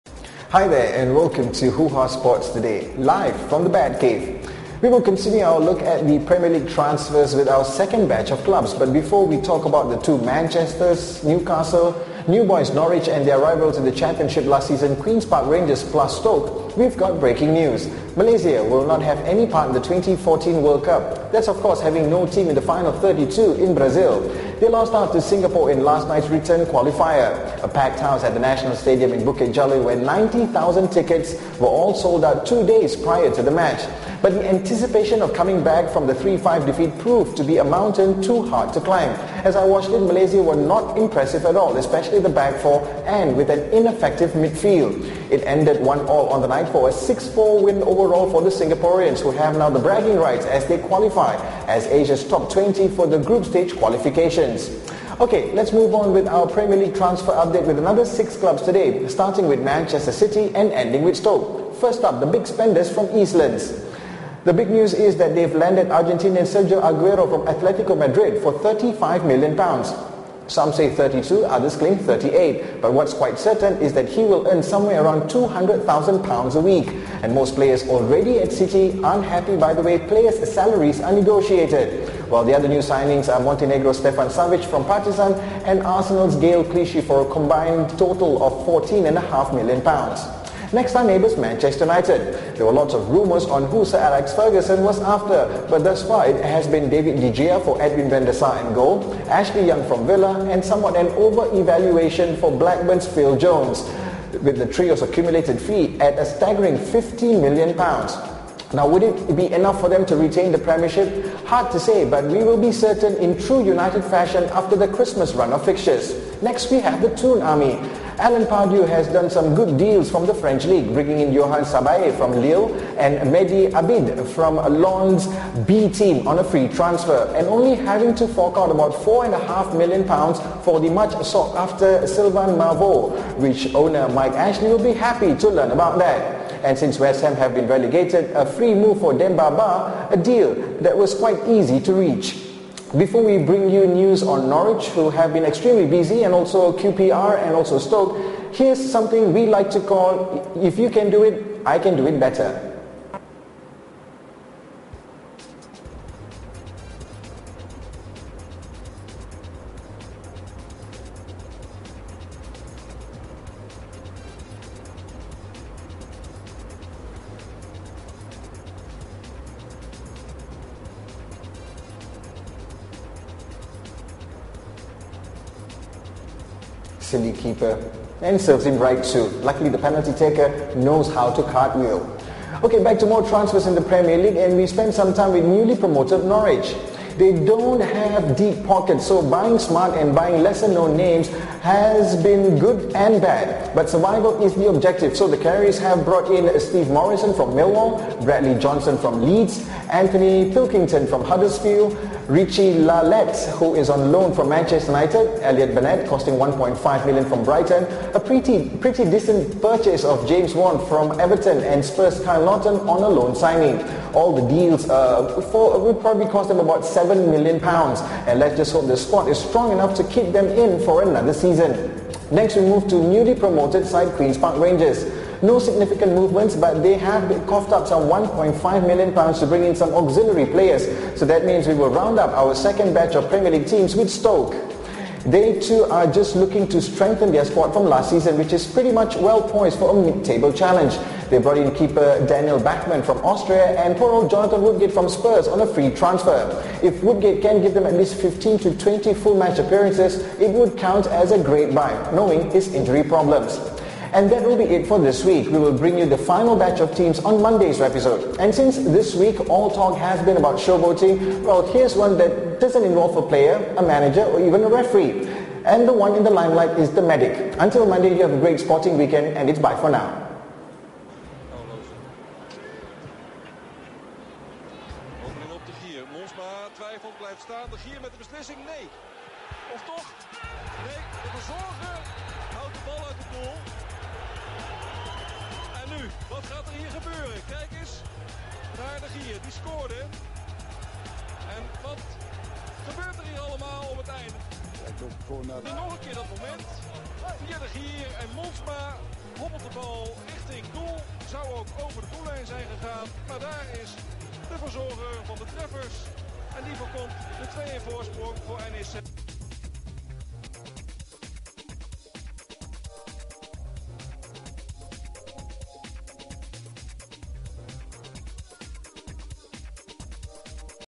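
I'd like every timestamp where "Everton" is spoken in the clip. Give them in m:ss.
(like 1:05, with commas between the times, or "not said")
3:31.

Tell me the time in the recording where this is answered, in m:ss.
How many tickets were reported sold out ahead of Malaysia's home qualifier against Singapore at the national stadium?
0:29.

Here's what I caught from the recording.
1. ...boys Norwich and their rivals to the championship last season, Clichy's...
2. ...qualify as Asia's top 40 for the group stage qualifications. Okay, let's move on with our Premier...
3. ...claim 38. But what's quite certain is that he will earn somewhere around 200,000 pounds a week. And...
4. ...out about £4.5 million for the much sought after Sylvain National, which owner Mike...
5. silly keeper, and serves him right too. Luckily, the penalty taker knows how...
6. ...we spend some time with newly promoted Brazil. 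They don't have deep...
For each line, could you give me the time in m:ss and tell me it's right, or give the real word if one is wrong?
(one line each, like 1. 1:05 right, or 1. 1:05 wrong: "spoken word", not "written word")
1. 0:12 wrong: "Queen", not "Clichy"
2. 0:50 wrong: "20", not "40"
3. 1:11 right
4. 2:08 wrong: "Marvaux", not "National"
5. 2:57 right
6. 3:04 wrong: "Norwich", not "Brazil".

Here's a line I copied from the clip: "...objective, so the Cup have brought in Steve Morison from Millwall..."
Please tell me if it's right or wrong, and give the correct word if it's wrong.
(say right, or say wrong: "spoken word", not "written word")
wrong: "Canaries", not "Cup".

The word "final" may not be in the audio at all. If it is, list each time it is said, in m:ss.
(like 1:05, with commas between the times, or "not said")
0:22, 4:16.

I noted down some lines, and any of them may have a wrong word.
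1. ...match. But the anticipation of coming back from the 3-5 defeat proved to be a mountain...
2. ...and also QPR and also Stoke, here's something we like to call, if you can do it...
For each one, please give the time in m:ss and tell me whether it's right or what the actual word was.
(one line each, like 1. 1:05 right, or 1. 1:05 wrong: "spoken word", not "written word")
1. 0:33 right
2. 2:26 right.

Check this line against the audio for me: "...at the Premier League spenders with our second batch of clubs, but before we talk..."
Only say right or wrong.
wrong.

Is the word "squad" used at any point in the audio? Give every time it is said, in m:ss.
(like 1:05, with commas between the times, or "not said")
3:38, 3:57.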